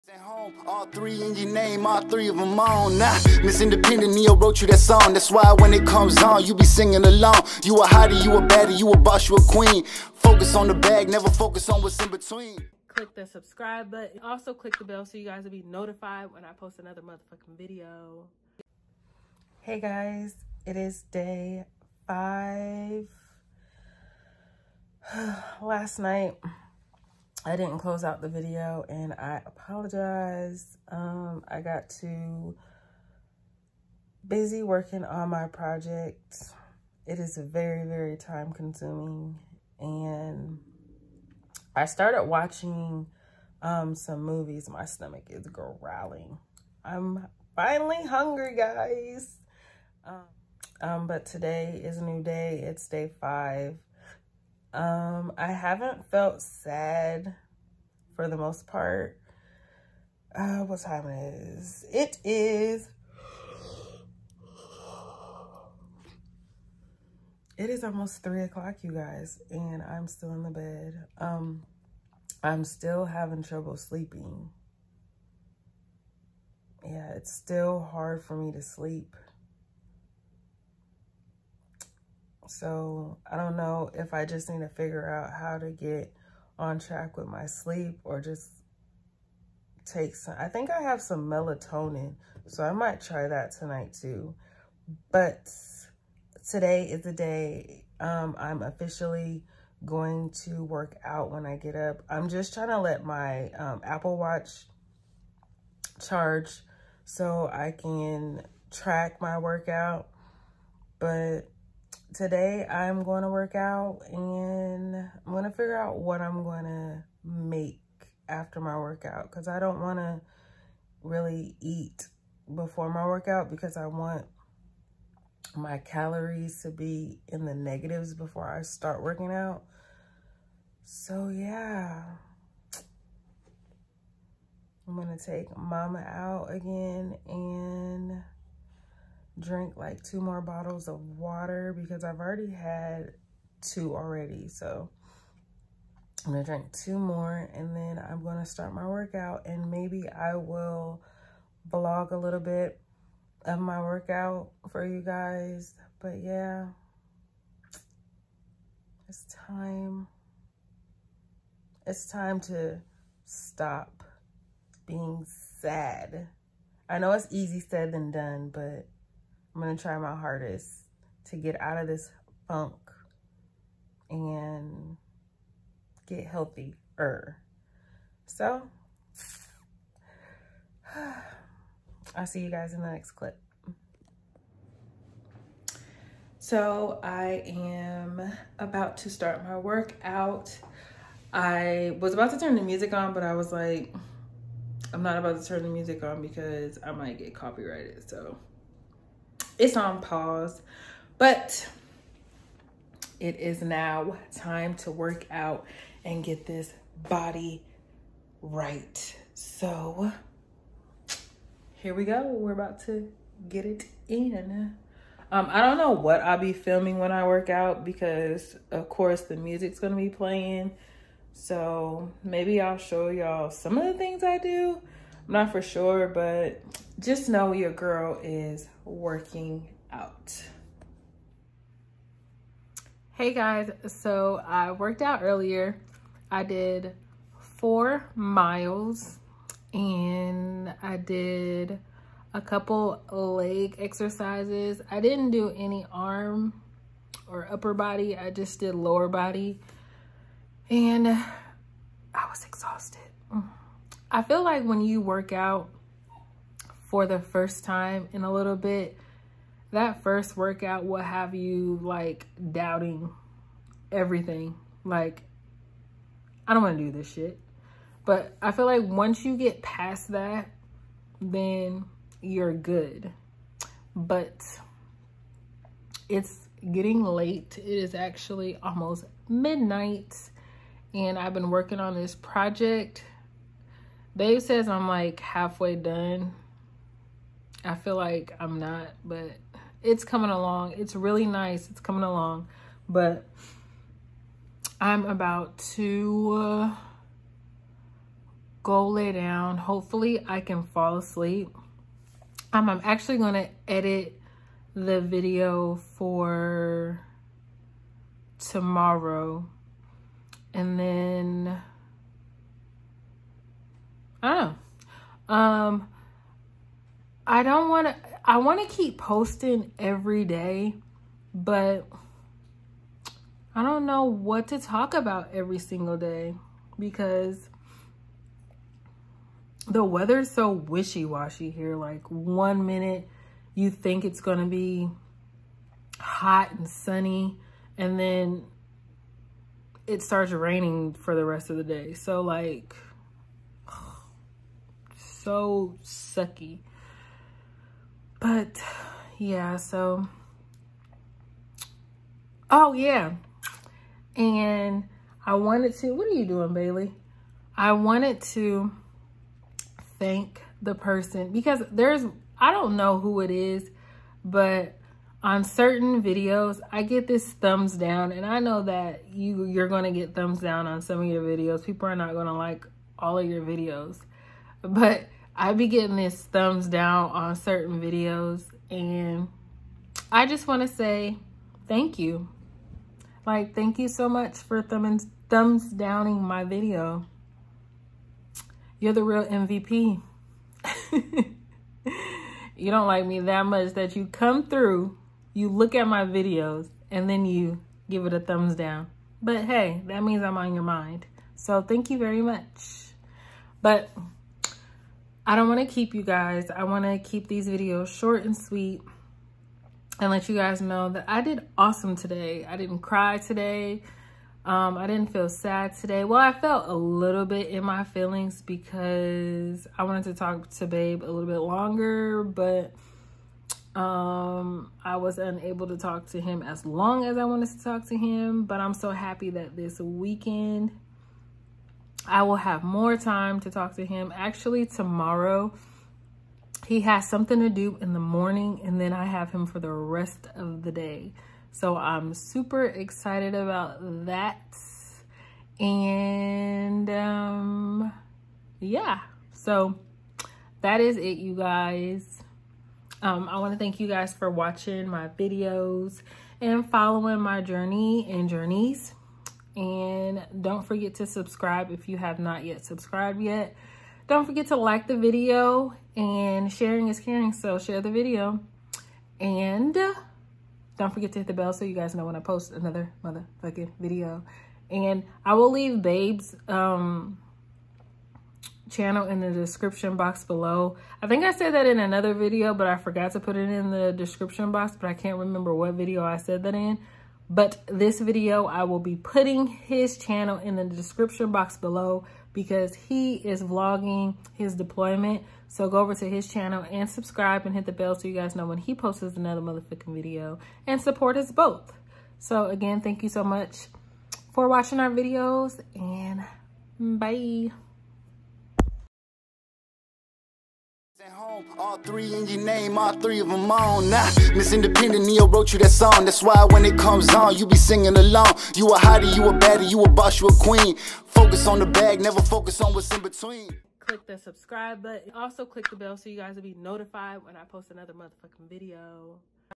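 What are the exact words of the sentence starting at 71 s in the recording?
Um, I'm still having trouble sleeping.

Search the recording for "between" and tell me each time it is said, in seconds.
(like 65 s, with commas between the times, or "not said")
12 s, 523 s.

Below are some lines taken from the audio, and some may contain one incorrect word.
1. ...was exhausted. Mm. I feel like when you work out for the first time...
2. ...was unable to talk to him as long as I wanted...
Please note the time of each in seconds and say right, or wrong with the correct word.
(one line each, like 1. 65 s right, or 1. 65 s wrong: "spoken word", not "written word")
1. 252 s right
2. 424 s right.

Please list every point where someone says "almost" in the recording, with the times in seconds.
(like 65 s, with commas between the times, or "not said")
67 s, 278 s.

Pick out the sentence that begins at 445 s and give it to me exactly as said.
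And um, yeah, so that is it, you guys.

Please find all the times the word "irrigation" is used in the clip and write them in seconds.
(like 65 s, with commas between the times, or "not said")
not said.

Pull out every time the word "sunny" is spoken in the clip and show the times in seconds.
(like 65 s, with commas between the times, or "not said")
336 s.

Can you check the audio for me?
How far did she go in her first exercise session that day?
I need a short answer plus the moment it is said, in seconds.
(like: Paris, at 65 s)
4 miles, at 237 s.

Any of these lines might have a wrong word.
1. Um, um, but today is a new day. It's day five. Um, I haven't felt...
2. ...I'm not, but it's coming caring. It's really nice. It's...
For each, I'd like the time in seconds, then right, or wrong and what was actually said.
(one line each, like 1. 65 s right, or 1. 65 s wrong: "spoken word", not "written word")
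1. 50 s right
2. 288 s wrong: "along", not "caring".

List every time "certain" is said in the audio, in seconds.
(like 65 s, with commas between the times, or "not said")
365 s, 377 s.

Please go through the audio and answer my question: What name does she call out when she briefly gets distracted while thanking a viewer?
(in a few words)
Bailey.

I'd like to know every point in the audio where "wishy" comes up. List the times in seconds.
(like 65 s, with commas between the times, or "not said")
330 s.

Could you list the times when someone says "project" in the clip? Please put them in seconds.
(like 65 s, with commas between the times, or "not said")
35 s, 282 s.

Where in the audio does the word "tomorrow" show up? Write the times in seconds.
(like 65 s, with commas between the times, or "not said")
308 s, 434 s.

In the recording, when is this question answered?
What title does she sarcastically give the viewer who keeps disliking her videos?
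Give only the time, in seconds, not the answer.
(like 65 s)
388 s.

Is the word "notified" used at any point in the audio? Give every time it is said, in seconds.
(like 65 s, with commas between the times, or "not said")
15 s, 526 s.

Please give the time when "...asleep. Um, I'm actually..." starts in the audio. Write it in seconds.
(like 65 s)
300 s.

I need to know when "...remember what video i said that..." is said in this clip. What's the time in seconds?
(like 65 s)
485 s.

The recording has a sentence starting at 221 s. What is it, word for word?
So maybe I'll show y'all some of the things I do.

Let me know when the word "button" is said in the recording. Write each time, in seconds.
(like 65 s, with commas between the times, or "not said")
13 s, 524 s.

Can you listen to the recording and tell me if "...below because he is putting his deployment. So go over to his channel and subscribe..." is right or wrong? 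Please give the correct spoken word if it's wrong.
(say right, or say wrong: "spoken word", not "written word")
wrong: "vlogging", not "putting".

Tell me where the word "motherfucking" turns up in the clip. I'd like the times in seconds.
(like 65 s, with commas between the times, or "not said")
17 s, 473 s, 499 s, 527 s.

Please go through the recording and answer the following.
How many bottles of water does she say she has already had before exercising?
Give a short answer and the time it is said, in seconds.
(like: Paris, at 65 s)
2, at 143 s.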